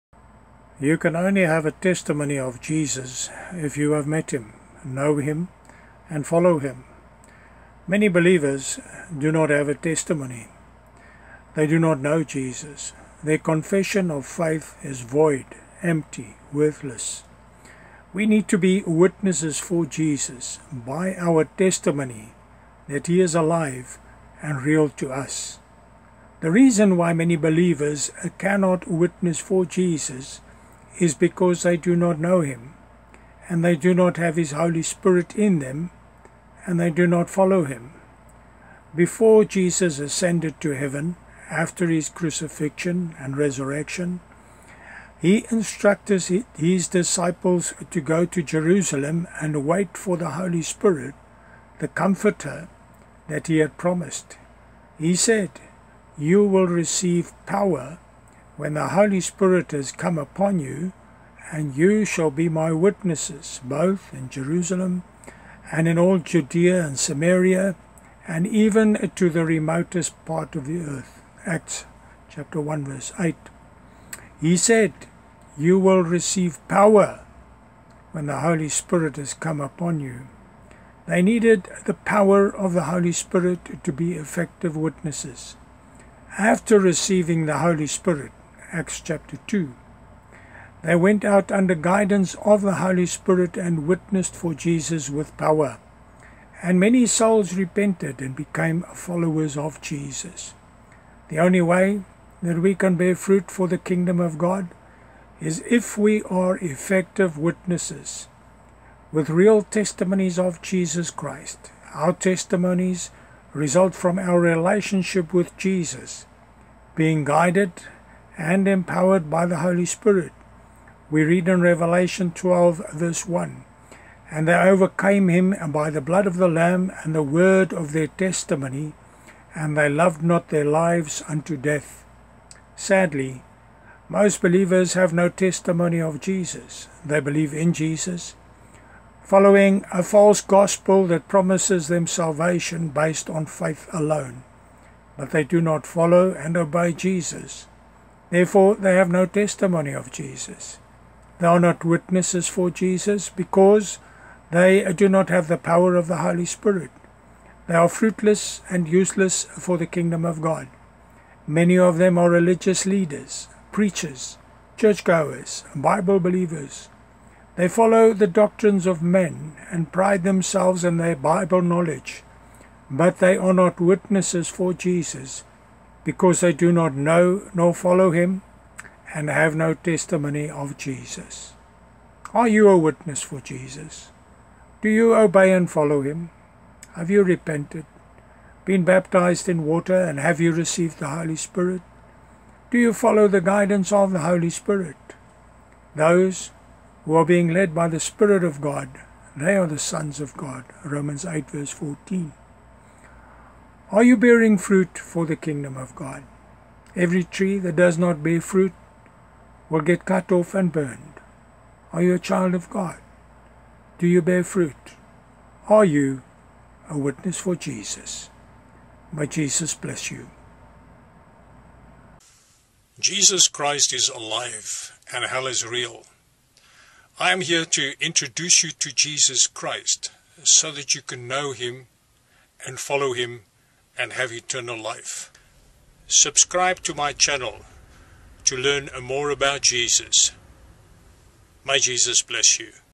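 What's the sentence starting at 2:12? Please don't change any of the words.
Sadly, most believers have no testimony of Jesus.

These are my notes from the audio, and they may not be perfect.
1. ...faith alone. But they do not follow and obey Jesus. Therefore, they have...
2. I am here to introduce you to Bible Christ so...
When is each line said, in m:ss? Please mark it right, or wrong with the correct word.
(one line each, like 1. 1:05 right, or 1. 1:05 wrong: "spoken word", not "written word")
1. 2:23 right
2. 3:47 wrong: "Jesus", not "Bible".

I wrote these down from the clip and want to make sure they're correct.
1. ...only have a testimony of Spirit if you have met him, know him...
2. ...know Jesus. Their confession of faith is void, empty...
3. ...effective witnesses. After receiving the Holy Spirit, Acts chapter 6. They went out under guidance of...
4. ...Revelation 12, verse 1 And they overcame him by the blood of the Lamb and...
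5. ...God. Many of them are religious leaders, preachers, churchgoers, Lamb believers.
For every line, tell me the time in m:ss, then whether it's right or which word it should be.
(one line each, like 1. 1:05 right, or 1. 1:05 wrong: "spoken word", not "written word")
1. 0:01 wrong: "Jesus", not "Spirit"
2. 0:11 right
3. 1:24 wrong: "2", not "6"
4. 2:01 right
5. 2:40 wrong: "Bible", not "Lamb".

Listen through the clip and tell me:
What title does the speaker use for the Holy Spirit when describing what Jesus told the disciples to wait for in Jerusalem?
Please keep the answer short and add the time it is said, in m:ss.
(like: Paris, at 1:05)
The Comforter, at 0:51.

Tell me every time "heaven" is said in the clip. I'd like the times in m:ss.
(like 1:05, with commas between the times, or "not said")
0:40.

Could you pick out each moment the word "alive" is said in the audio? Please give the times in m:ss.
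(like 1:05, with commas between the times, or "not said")
0:23, 3:44.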